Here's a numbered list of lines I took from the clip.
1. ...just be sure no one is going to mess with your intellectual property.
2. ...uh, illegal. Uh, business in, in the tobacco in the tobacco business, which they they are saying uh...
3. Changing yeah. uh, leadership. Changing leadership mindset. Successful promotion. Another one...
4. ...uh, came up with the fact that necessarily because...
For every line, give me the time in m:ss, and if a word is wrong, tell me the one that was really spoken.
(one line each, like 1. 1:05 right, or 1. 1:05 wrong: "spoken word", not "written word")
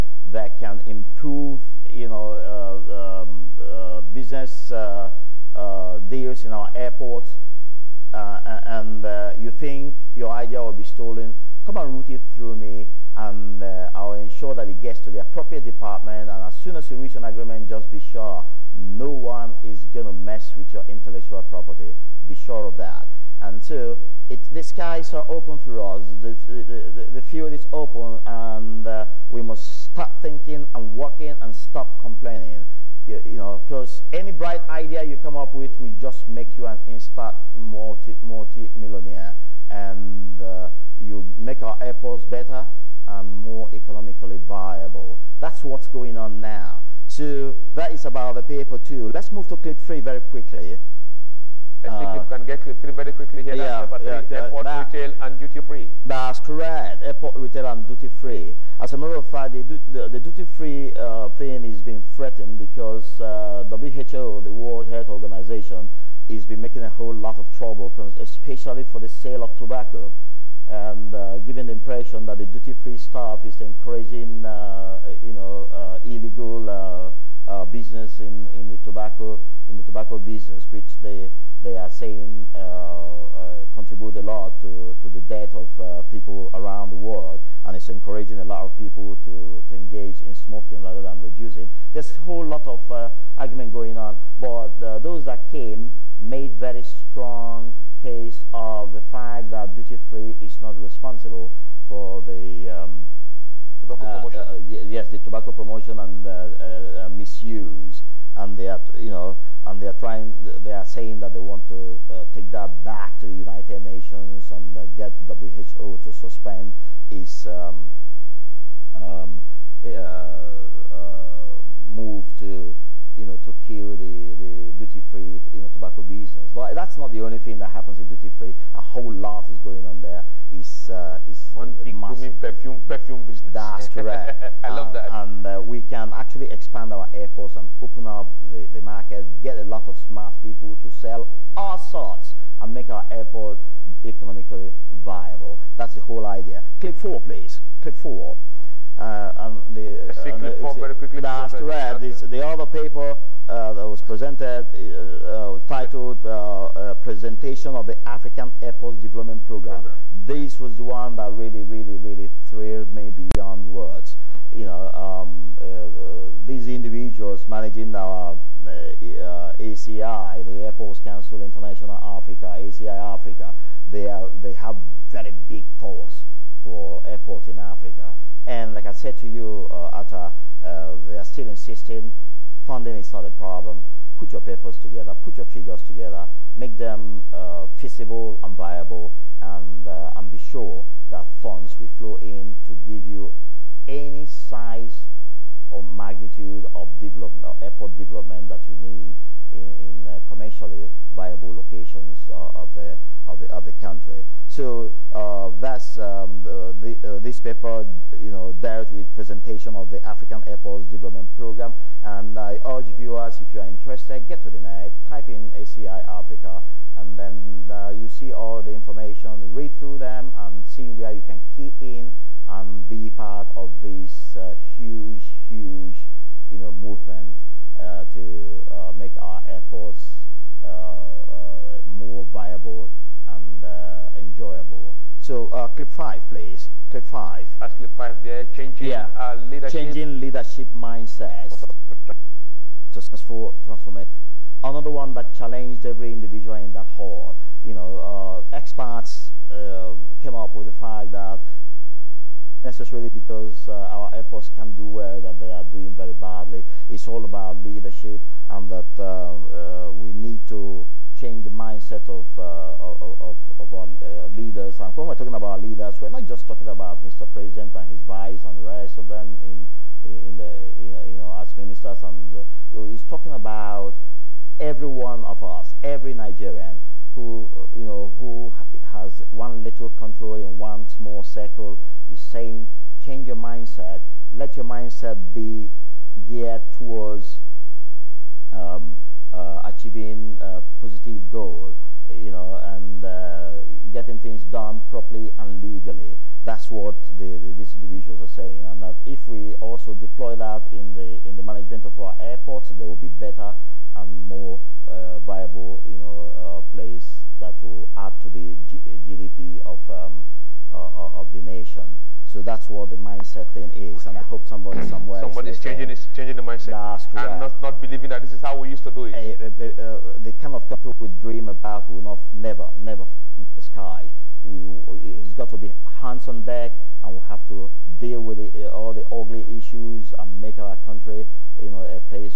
1. 0:17 right
2. 1:15 right
3. 3:58 wrong: "transformation", not "promotion"
4. 4:09 right.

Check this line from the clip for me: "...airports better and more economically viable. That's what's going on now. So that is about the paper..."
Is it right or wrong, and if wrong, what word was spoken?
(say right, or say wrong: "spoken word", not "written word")
right.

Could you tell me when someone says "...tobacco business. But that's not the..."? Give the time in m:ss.
2:05.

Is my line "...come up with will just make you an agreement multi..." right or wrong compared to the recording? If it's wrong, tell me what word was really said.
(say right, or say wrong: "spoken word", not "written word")
wrong: "instant", not "agreement".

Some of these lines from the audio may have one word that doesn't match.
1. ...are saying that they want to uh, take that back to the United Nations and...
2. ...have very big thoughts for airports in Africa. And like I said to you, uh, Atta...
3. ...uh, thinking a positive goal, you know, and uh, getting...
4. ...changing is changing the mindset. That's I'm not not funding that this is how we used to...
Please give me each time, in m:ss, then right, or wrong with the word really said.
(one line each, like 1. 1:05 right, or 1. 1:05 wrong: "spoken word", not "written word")
1. 1:50 right
2. 2:54 right
3. 4:49 wrong: "achieving", not "thinking"
4. 5:15 wrong: "believing", not "funding".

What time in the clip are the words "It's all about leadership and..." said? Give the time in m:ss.
4:16.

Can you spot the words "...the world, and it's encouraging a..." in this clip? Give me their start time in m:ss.
1:26.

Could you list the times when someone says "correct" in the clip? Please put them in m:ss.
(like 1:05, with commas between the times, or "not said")
0:56, 2:13.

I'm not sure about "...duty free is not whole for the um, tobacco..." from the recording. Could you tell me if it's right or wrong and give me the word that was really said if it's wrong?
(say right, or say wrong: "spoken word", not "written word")
wrong: "responsible", not "whole".